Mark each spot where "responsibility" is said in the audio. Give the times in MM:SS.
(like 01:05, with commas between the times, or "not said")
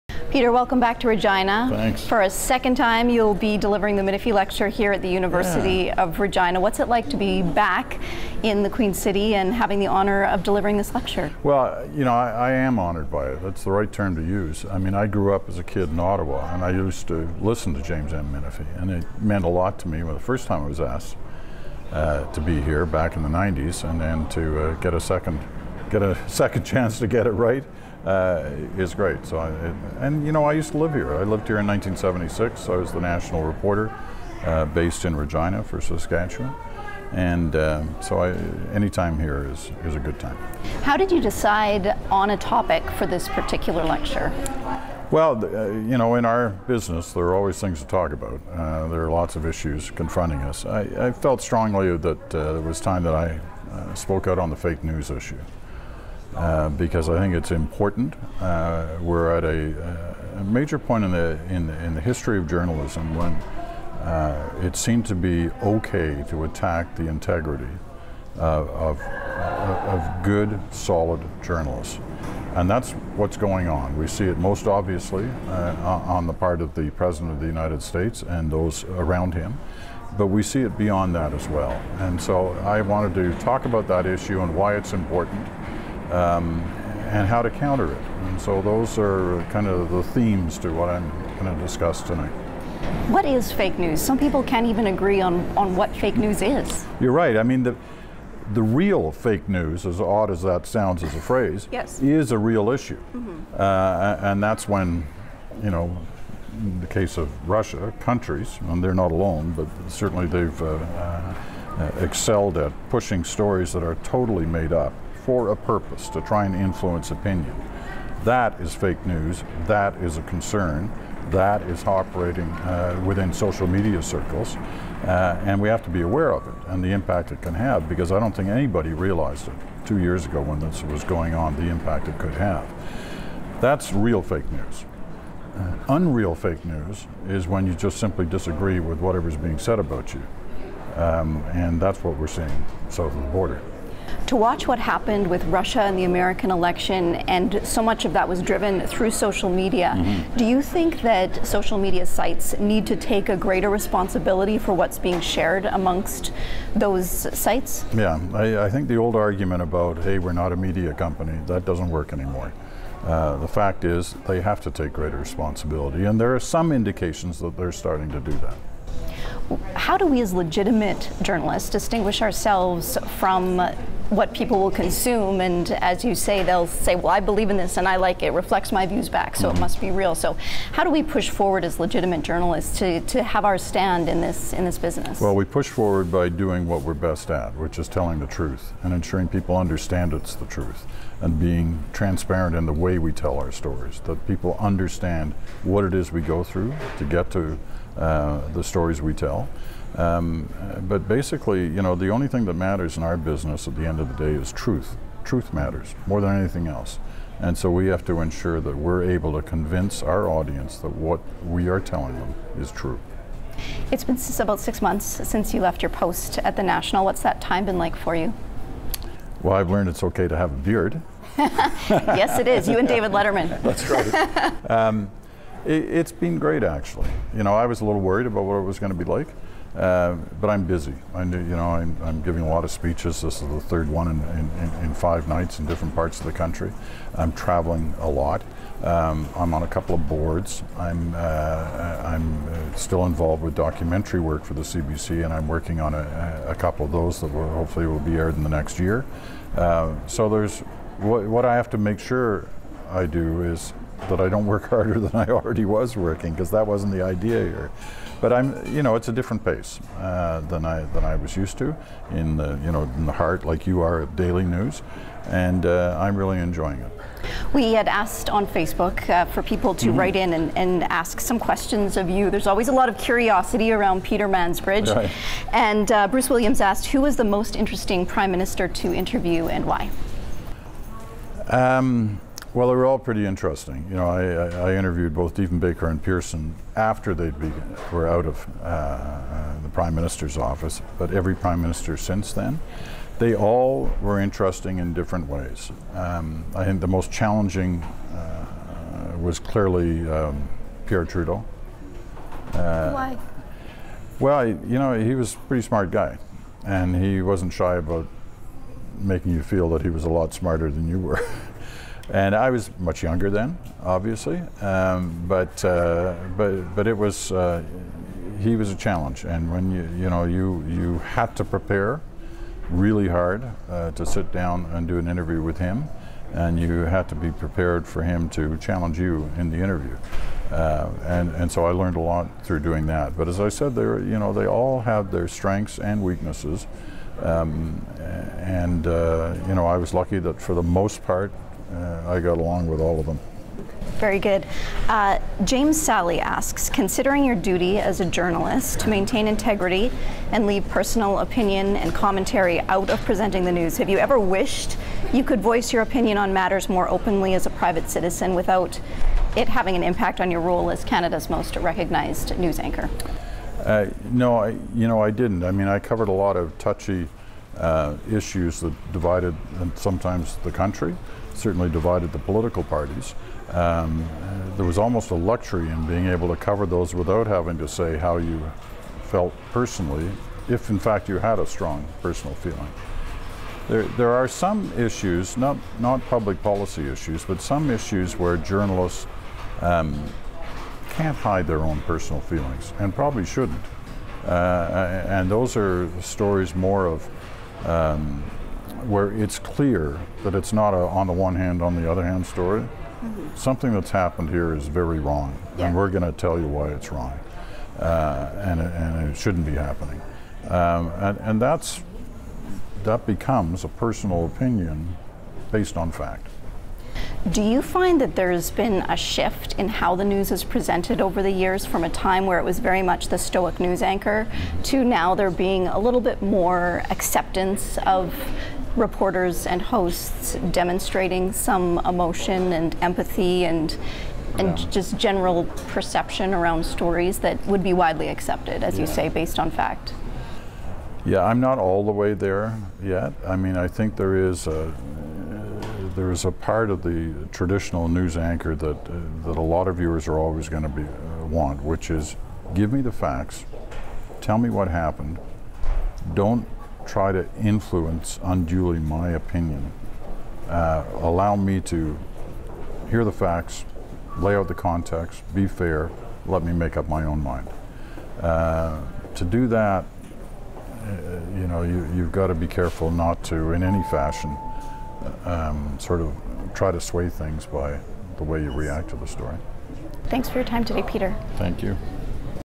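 02:33, 02:45.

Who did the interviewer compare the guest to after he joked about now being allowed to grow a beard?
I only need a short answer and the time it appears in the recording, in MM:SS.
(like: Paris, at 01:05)
David Letterman, at 03:42.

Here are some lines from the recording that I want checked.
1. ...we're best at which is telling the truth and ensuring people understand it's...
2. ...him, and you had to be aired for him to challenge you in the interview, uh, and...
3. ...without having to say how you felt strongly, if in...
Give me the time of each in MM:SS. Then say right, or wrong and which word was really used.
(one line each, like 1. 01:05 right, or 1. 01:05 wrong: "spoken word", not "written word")
1. 03:06 right
2. 05:25 wrong: "prepared", not "aired"
3. 06:16 wrong: "personally", not "strongly".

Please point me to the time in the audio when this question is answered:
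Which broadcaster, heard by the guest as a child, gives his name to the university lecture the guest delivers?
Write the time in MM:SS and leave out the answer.
00:17.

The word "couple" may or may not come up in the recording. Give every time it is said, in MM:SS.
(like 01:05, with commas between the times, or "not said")
03:59, 04:06.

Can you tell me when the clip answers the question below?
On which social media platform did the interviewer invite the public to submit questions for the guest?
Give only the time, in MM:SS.
04:28.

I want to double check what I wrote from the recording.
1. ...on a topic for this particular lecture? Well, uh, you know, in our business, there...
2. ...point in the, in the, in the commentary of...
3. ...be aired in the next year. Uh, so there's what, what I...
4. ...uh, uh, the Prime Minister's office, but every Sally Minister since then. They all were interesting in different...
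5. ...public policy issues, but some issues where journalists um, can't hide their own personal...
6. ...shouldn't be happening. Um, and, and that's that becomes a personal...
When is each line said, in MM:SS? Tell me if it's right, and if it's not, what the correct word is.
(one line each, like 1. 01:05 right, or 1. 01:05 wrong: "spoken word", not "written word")
1. 00:42 right
2. 01:00 wrong: "history", not "commentary"
3. 04:07 right
4. 04:48 wrong: "Prime", not "Sally"
5. 06:26 right
6. 06:49 right.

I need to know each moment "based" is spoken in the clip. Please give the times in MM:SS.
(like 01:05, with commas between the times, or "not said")
00:34, 06:55, 07:19.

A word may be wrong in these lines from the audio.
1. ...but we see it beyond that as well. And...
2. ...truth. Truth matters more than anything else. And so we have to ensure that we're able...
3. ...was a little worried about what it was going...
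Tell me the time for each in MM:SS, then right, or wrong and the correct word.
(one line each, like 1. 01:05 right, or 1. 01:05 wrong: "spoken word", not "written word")
1. 01:20 right
2. 03:24 right
3. 03:47 right.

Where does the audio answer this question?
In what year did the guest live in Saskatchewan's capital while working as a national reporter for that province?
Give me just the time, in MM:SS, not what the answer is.
00:31.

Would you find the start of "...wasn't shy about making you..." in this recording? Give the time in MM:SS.
05:07.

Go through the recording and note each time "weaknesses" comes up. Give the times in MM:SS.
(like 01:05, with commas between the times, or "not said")
05:36.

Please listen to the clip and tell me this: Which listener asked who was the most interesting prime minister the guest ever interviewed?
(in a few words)
Bruce Williams.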